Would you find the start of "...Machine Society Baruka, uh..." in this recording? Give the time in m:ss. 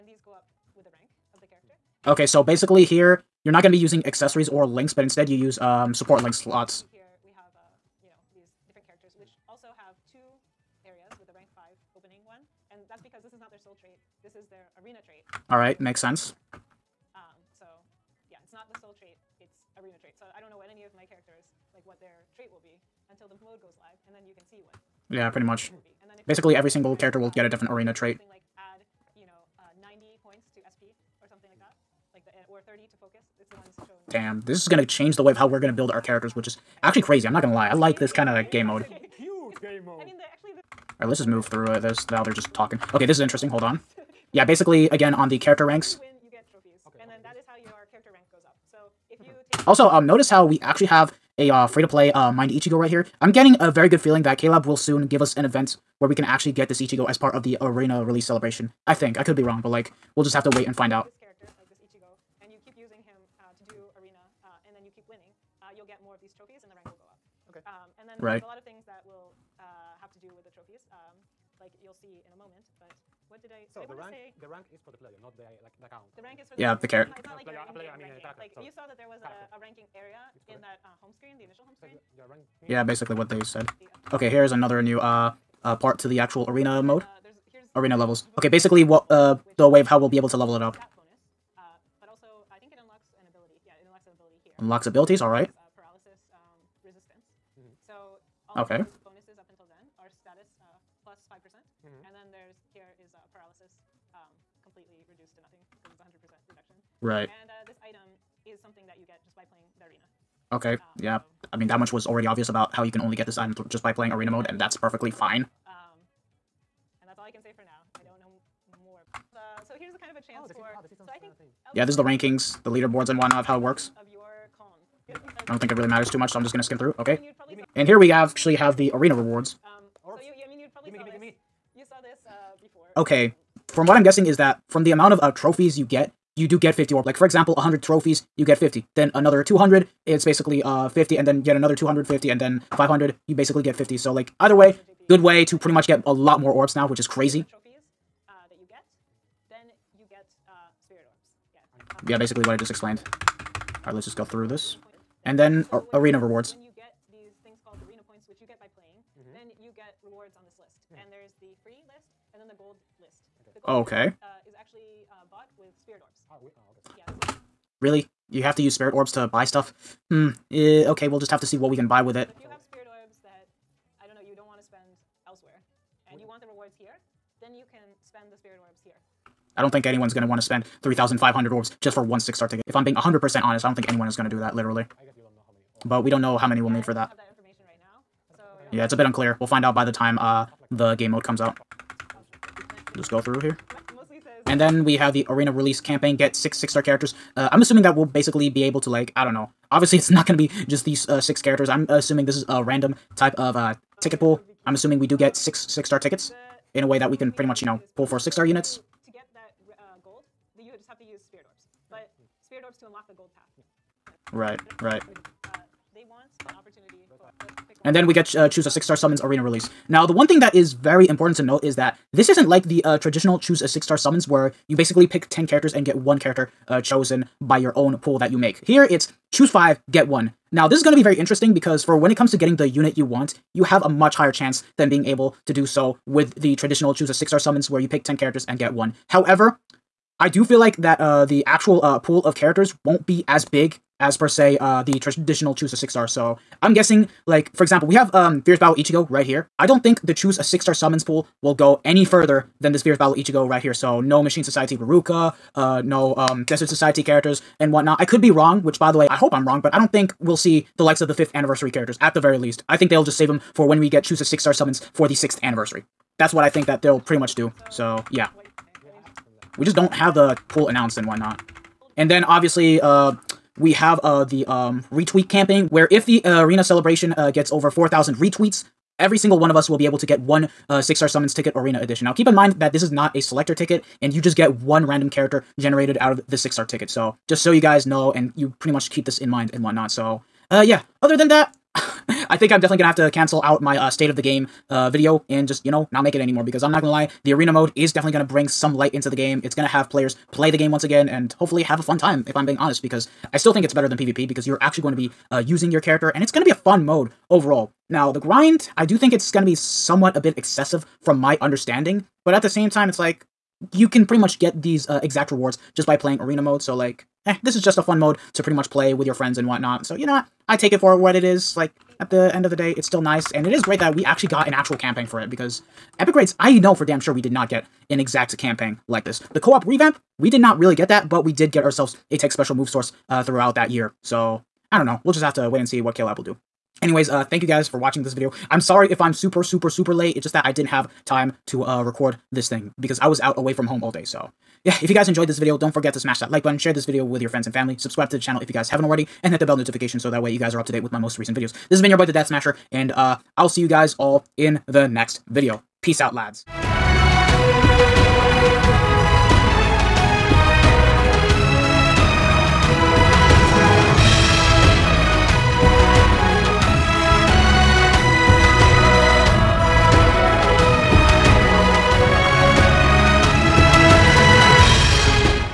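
4:14.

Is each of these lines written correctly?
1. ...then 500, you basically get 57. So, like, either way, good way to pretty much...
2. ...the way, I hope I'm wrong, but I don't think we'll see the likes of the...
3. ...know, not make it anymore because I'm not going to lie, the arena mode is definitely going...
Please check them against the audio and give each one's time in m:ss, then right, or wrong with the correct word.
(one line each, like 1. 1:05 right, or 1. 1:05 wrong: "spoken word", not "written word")
1. 2:22 wrong: "50", not "57"
2. 4:18 right
3. 4:55 right.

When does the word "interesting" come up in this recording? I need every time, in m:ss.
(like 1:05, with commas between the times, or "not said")
0:43, 3:51.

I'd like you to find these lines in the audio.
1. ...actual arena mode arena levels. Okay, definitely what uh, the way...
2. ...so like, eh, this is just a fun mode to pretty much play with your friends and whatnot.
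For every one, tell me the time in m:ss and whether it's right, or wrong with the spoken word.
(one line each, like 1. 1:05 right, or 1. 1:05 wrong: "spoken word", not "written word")
1. 1:26 wrong: "basically", not "definitely"
2. 5:16 right.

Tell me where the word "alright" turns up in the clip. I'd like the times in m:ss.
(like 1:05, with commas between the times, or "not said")
0:41, 1:35, 2:33.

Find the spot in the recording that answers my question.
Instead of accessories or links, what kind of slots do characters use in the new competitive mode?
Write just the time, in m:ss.
0:05.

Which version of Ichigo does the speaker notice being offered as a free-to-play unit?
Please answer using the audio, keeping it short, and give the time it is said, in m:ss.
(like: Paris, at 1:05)
Mind Ichigo, at 0:52.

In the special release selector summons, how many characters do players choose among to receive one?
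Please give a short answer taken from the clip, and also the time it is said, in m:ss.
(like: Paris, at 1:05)
5, at 3:49.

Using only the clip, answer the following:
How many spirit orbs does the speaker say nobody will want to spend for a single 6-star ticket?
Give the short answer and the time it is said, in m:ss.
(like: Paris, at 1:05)
3,500, at 3:00.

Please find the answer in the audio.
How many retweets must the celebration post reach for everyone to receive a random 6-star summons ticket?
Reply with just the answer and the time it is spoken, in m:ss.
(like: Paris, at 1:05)
4,000, at 4:37.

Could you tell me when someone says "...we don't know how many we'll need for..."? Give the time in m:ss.
3:06.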